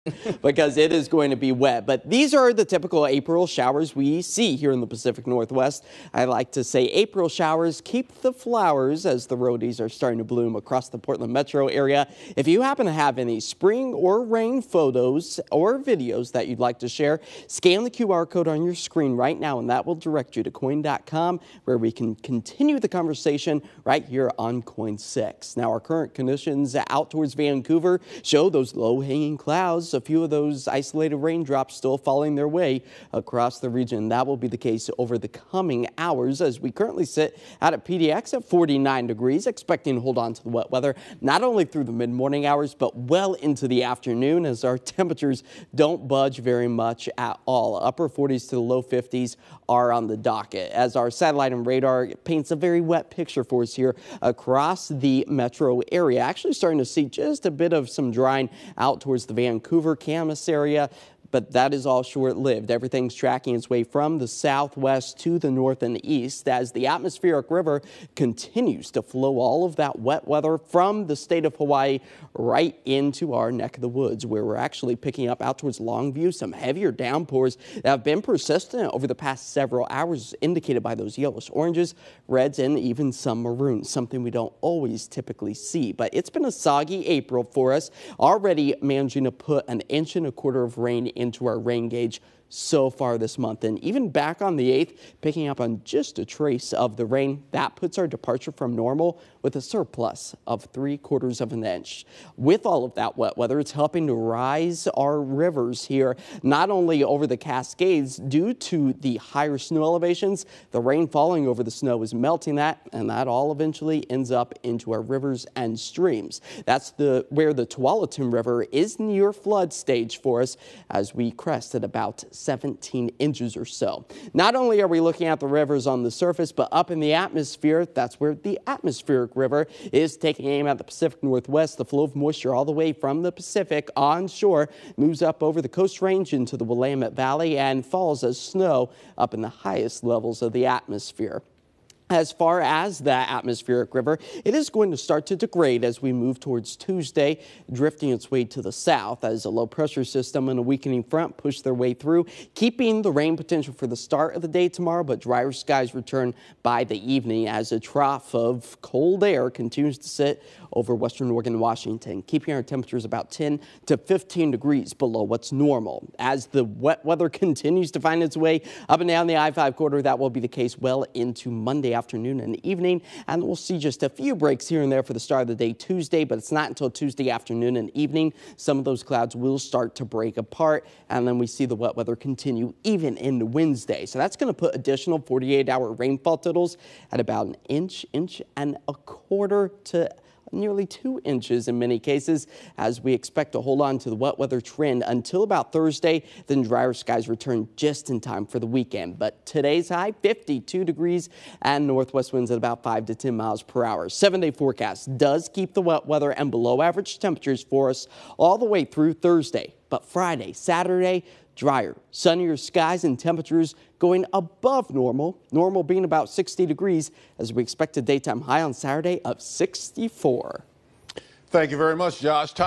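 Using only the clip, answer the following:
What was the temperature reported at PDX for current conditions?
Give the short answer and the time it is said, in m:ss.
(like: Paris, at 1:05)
49 degrees, at 0:38.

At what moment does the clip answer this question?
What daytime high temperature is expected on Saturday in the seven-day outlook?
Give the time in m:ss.
3:39.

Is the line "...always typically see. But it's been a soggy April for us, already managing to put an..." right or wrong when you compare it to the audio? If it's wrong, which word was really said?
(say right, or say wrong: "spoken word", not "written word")
right.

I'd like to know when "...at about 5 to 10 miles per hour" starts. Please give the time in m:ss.
3:22.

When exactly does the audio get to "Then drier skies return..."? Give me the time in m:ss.
3:16.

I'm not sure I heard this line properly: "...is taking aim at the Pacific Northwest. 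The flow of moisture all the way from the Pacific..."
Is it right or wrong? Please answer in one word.
right.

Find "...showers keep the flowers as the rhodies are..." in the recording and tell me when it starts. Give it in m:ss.
0:07.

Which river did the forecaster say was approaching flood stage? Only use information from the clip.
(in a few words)
Tualatin River.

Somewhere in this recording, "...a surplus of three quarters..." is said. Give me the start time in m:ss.
1:39.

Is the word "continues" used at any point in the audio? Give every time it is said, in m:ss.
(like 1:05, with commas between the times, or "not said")
0:22, 1:08, 2:39, 2:47, 3:02.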